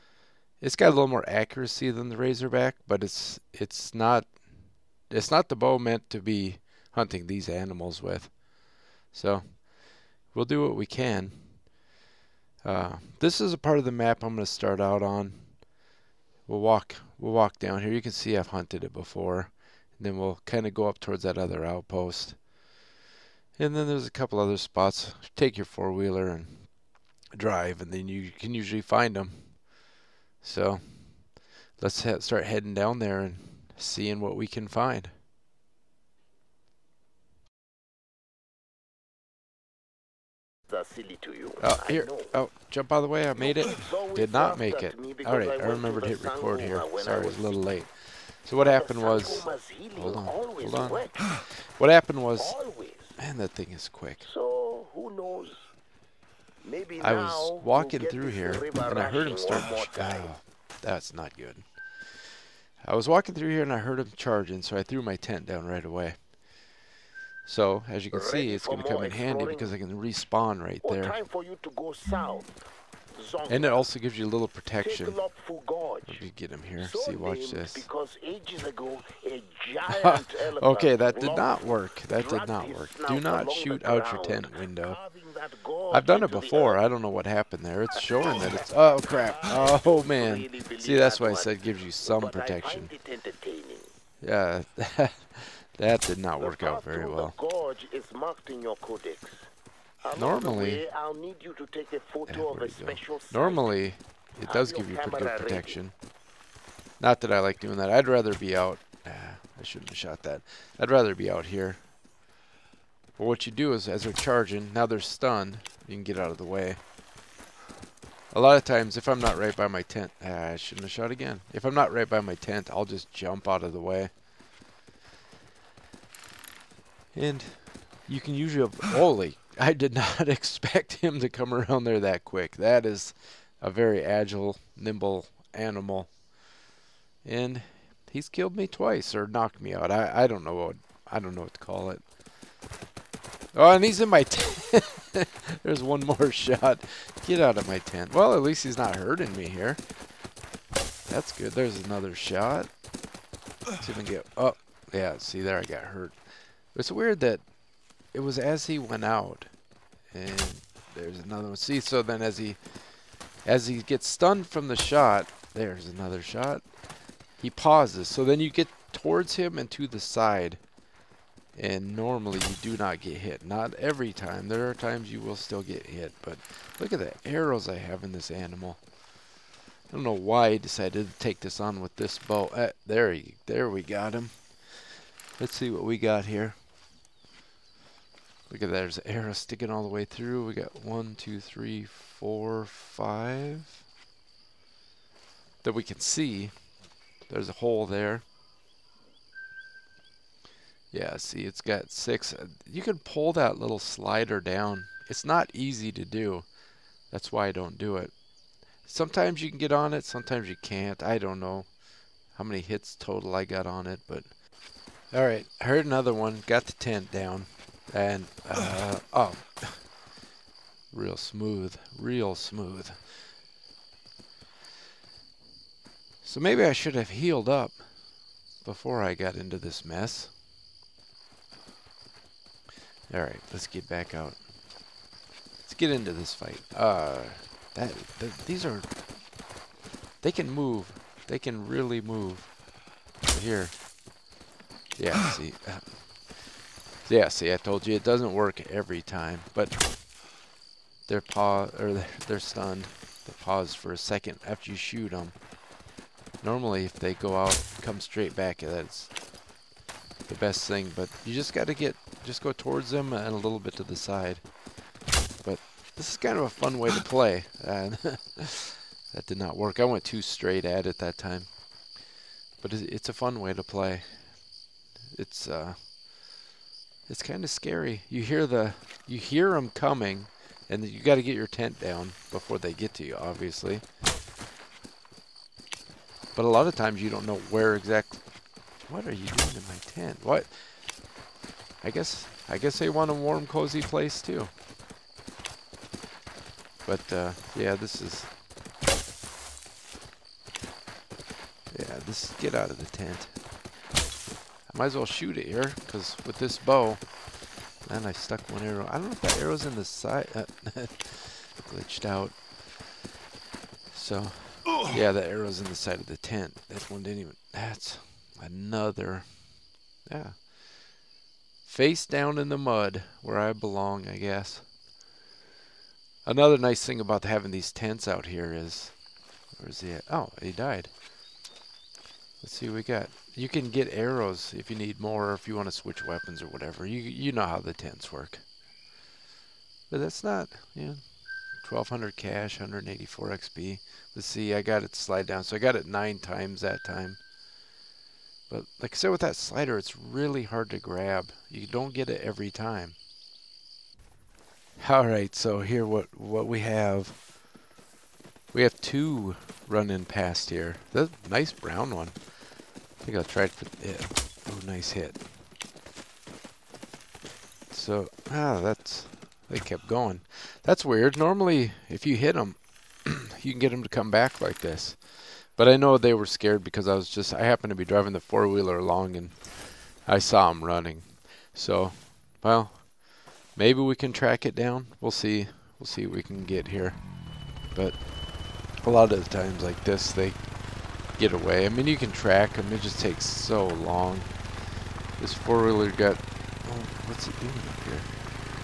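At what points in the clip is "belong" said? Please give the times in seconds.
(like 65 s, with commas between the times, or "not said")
323 s.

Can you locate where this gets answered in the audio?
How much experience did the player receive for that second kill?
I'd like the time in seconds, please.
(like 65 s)
342 s.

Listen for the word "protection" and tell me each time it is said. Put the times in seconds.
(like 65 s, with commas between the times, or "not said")
74 s, 92 s, 105 s.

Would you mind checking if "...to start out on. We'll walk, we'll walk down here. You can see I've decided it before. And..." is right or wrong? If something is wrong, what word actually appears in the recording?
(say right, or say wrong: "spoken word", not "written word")
wrong: "hunted", not "decided".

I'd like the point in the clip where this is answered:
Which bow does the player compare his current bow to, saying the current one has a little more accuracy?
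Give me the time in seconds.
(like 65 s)
2 s.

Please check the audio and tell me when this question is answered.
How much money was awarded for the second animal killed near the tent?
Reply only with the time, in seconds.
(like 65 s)
341 s.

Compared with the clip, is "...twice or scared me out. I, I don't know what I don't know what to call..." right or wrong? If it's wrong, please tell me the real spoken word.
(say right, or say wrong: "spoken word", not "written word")
wrong: "knocked", not "scared".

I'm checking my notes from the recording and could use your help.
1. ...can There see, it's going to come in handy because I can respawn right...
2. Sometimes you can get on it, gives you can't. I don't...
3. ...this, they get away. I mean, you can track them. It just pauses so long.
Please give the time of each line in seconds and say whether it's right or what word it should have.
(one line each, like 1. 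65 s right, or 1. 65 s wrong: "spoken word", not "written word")
1. 68 s wrong: "Ready", not "There"
2. 208 s wrong: "sometimes", not "gives"
3. 389 s wrong: "takes", not "pauses".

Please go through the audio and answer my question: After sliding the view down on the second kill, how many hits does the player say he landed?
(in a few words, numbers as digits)
9.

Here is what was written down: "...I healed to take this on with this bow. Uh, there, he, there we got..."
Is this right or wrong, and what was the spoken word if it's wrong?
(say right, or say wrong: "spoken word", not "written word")
wrong: "decided", not "healed".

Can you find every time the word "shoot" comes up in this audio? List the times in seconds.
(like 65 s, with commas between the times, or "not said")
83 s, 254 s, 305 s.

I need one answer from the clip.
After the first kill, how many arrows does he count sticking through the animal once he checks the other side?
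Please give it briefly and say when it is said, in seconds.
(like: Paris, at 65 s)
6, at 201 s.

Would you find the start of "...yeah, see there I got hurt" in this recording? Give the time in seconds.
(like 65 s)
154 s.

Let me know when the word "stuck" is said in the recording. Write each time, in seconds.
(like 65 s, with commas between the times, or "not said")
308 s.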